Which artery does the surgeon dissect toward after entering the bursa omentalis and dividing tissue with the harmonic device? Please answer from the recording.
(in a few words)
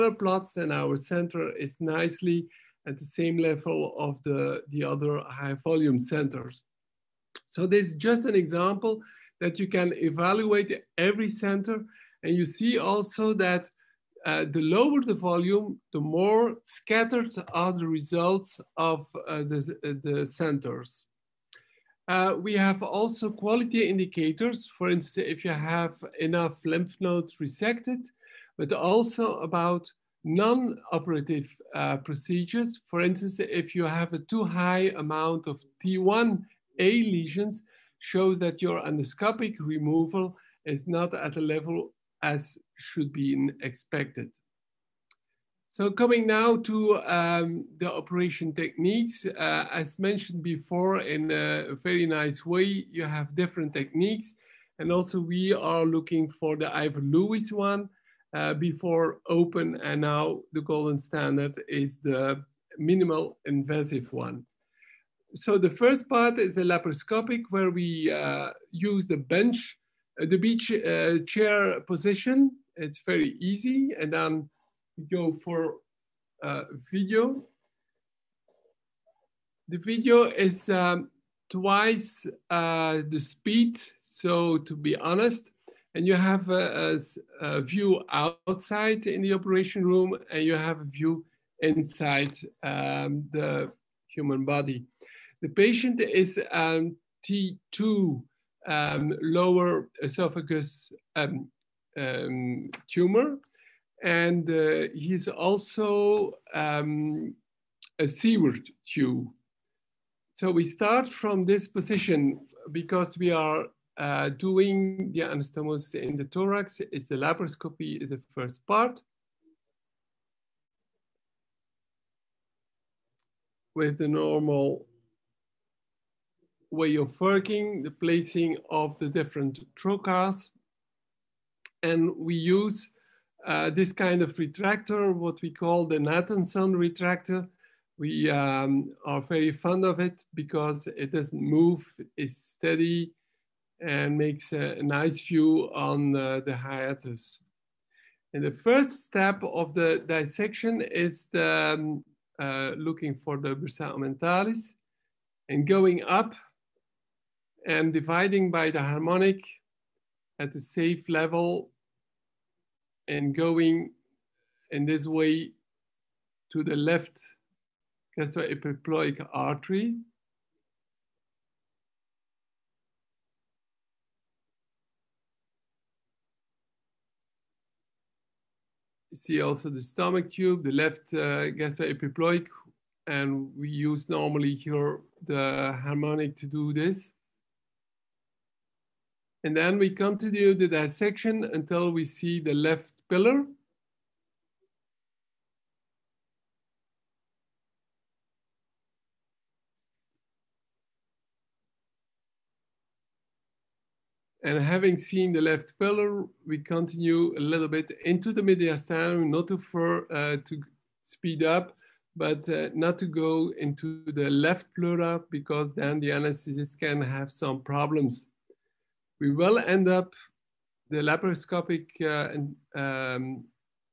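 left gastroepiploic artery.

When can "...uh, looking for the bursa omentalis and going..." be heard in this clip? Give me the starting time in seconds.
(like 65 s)
152 s.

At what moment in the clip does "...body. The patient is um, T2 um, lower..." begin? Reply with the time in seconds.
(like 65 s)
94 s.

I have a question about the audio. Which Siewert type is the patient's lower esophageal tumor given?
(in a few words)
Siewert 2.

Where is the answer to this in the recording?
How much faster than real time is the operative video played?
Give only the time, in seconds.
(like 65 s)
81 s.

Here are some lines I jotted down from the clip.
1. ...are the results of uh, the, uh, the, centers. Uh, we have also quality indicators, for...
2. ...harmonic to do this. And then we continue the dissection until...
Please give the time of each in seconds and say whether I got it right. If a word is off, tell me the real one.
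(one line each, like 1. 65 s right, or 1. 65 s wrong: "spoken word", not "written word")
1. 17 s right
2. 185 s right.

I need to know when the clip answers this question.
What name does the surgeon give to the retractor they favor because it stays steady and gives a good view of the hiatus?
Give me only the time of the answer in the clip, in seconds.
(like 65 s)
135 s.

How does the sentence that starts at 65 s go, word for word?
So the first part is the laparoscopic where we uh, use the bench uh, the beach uh, chair position, it's very easy.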